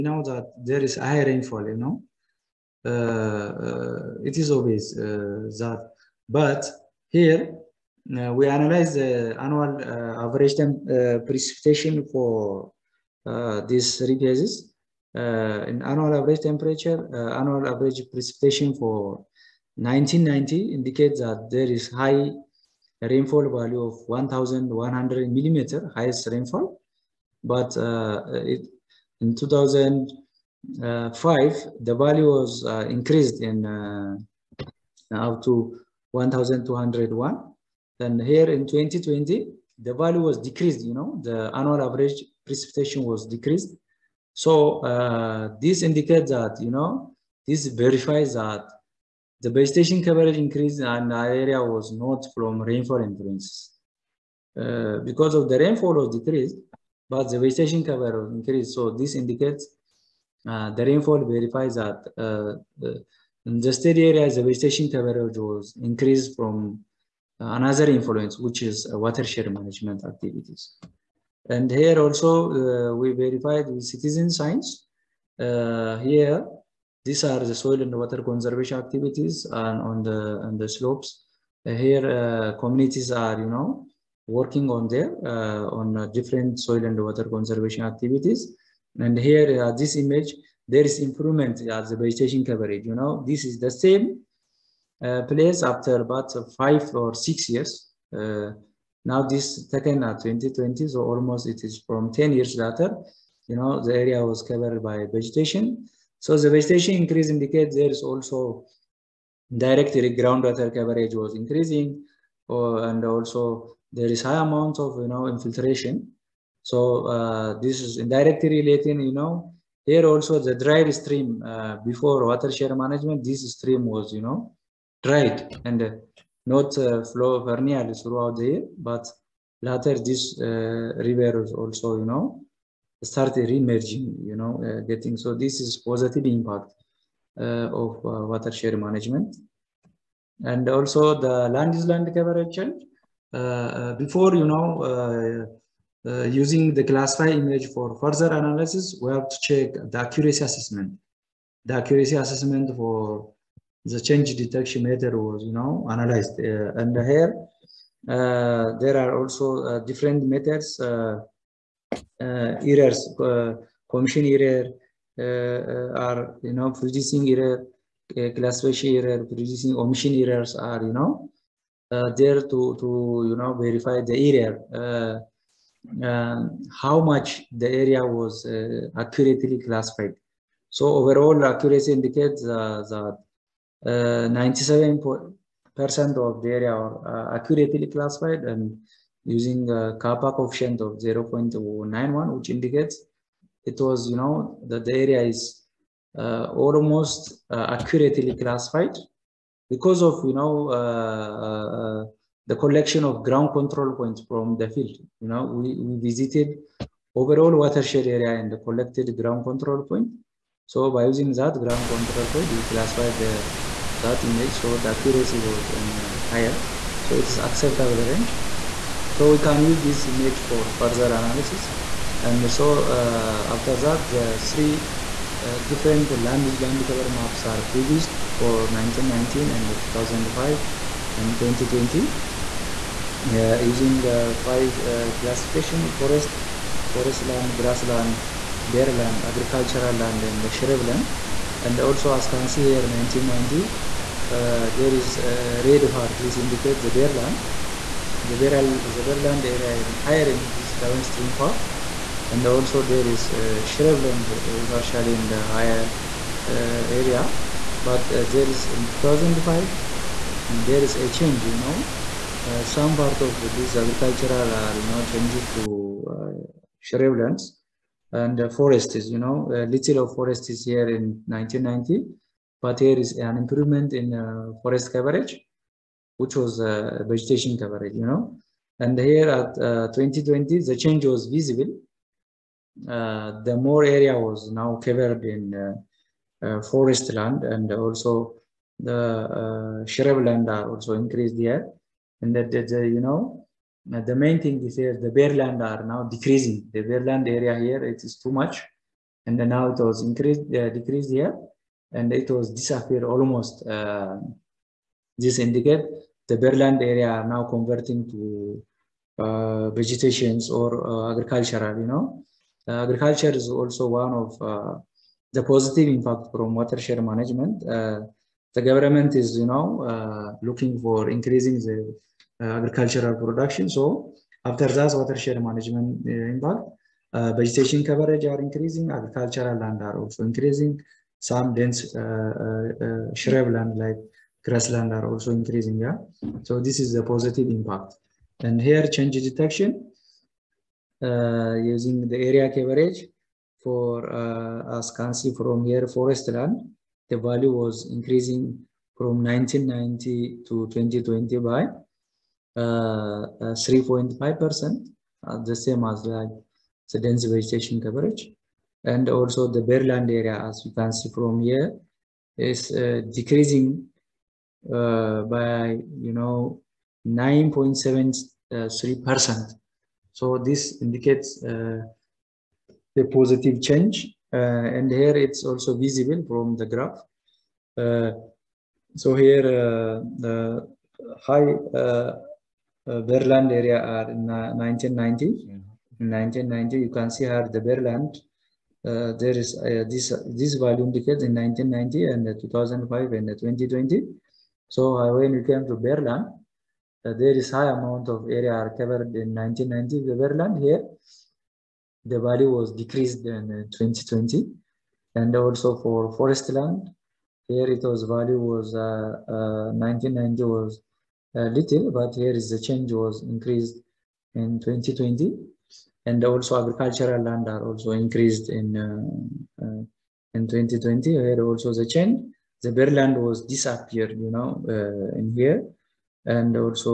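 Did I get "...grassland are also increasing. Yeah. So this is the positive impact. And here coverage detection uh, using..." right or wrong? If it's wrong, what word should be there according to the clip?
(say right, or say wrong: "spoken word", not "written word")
wrong: "change", not "coverage".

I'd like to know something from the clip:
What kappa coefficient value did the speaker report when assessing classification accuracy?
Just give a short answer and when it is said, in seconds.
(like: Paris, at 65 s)
0.91, at 190 s.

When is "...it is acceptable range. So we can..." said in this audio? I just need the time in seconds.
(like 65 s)
217 s.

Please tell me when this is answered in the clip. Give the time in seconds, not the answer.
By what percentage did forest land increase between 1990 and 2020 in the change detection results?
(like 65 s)
352 s.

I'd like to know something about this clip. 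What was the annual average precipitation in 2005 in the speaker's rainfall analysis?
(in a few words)
1,201.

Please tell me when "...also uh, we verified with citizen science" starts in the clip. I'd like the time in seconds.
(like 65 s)
71 s.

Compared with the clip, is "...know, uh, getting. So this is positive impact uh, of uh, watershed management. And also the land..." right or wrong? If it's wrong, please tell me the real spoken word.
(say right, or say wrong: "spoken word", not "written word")
right.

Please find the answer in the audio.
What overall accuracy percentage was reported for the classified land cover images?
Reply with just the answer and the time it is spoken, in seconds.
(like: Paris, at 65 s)
97%, at 183 s.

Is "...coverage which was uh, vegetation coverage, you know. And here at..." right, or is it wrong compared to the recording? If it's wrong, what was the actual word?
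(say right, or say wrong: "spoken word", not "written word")
right.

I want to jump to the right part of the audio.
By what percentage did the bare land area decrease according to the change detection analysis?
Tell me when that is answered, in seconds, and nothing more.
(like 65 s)
367 s.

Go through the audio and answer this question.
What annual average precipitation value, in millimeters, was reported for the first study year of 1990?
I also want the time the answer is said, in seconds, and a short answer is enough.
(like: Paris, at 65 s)
1,100 millimeters, at 24 s.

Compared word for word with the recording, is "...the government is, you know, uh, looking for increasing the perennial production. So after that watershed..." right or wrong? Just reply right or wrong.
wrong.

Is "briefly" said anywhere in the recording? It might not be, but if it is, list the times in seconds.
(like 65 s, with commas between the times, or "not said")
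not said.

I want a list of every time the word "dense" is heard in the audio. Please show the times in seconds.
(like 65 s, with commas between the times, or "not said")
331 s, 356 s.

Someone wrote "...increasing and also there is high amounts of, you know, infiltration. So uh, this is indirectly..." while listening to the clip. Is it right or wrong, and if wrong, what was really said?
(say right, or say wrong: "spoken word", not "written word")
right.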